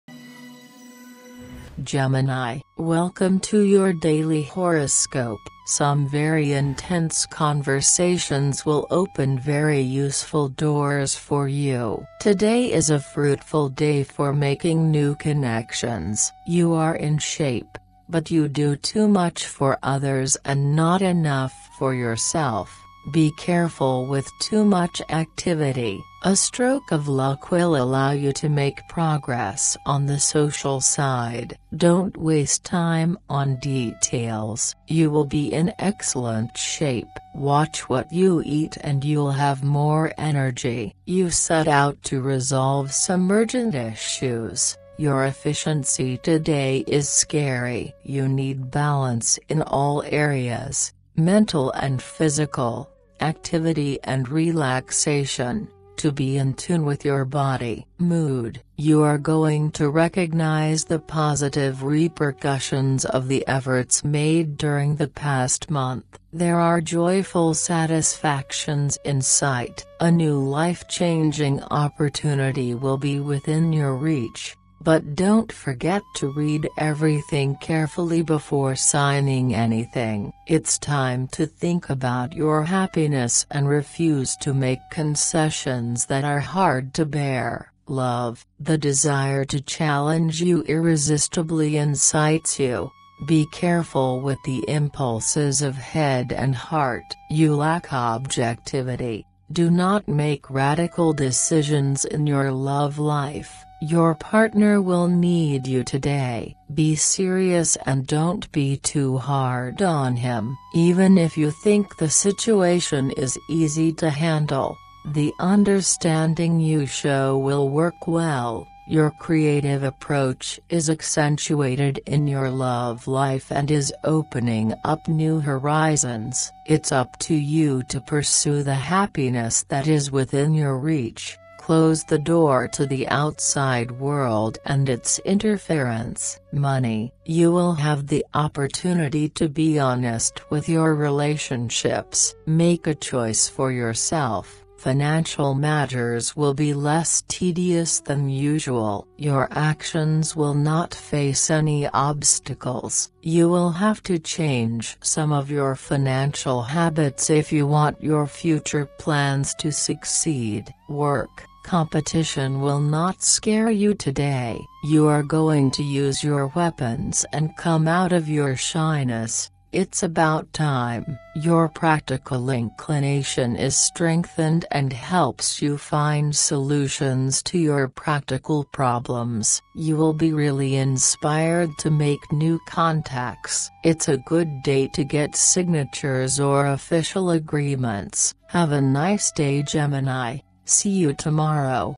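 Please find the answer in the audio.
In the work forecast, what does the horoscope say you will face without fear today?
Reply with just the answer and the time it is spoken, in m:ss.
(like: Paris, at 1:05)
Competition, at 2:41.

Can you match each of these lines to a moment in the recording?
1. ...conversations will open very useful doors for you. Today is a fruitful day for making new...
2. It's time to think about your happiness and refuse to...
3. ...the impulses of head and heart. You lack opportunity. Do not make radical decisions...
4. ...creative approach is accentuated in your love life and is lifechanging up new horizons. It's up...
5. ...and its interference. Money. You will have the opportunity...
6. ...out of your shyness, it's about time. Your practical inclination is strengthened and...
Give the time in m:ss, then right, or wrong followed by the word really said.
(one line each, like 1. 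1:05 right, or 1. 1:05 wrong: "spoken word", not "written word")
1. 0:07 right
2. 1:20 right
3. 1:34 wrong: "objectivity", not "opportunity"
4. 1:59 wrong: "opening", not "lifechanging"
5. 2:14 right
6. 2:47 right.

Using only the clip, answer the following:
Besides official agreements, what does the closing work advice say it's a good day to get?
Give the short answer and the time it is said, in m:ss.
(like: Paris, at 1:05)
signatures, at 3:05.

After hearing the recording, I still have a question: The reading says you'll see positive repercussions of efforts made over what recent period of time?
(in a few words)
past month.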